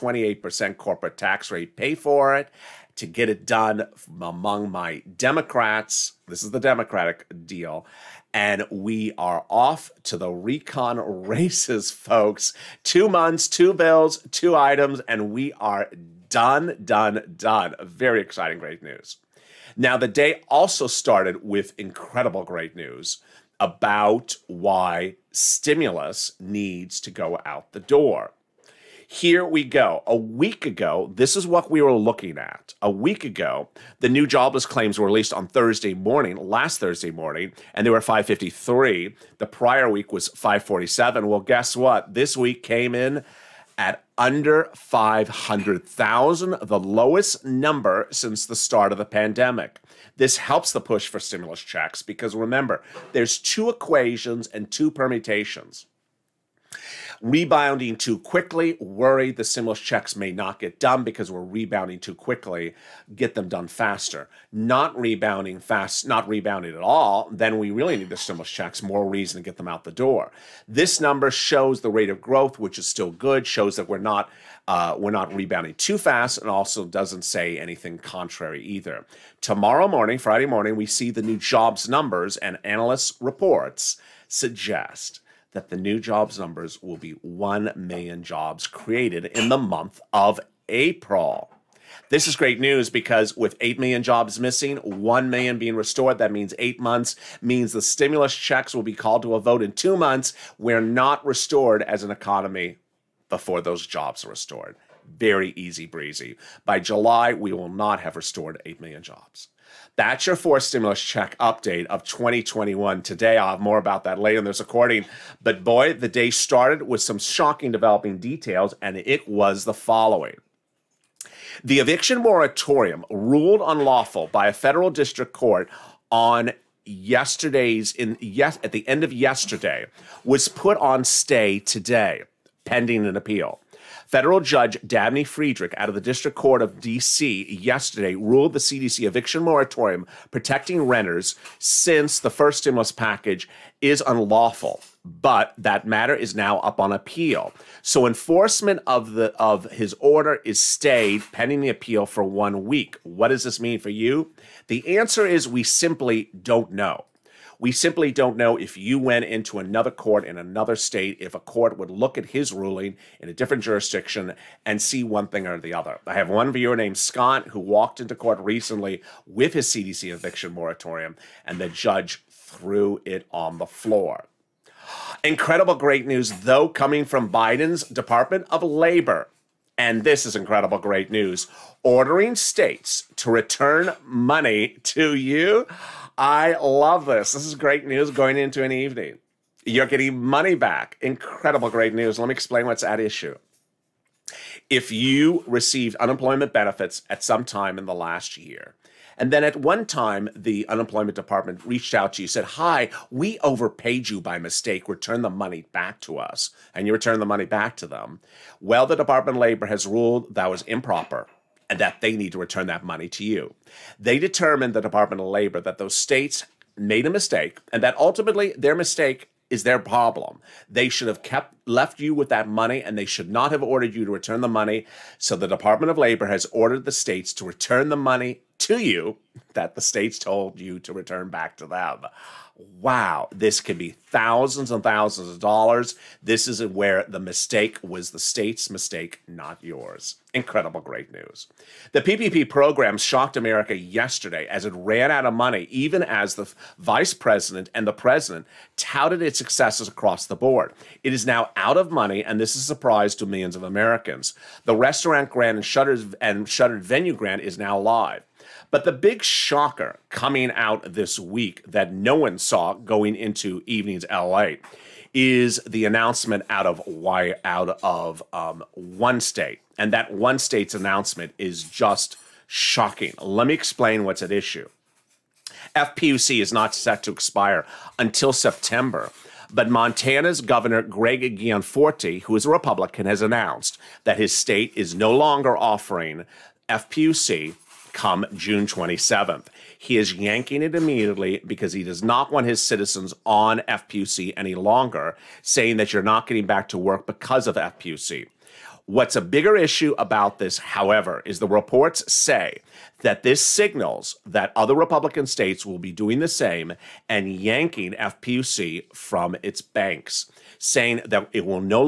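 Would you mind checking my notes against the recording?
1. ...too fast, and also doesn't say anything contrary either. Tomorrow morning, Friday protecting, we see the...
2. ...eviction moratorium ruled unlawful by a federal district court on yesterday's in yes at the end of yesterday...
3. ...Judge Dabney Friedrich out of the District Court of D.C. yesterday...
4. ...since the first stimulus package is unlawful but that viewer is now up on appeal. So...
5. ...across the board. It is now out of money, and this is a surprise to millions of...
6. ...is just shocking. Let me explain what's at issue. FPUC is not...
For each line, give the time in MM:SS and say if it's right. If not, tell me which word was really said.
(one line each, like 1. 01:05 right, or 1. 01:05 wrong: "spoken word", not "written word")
1. 01:15 wrong: "morning", not "protecting"
2. 02:01 right
3. 02:14 right
4. 02:21 wrong: "matter", not "viewer"
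5. 04:09 right
6. 04:31 right.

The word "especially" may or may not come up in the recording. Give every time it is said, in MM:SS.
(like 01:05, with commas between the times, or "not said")
not said.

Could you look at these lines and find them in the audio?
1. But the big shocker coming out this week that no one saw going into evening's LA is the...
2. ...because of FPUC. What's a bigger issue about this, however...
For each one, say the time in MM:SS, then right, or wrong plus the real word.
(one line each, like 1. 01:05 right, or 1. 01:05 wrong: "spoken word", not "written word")
1. 04:18 right
2. 04:57 right.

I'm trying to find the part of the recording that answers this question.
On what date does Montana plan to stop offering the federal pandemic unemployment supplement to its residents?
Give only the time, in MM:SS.
04:48.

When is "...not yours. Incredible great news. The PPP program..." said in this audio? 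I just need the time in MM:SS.
03:59.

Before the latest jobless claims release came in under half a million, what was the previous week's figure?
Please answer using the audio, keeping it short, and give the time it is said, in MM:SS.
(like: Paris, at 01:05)
553, at 00:38.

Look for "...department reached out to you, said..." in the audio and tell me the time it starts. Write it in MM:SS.
03:21.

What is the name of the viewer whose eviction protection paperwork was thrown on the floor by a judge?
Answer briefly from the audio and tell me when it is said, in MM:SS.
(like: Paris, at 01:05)
Scott, at 02:46.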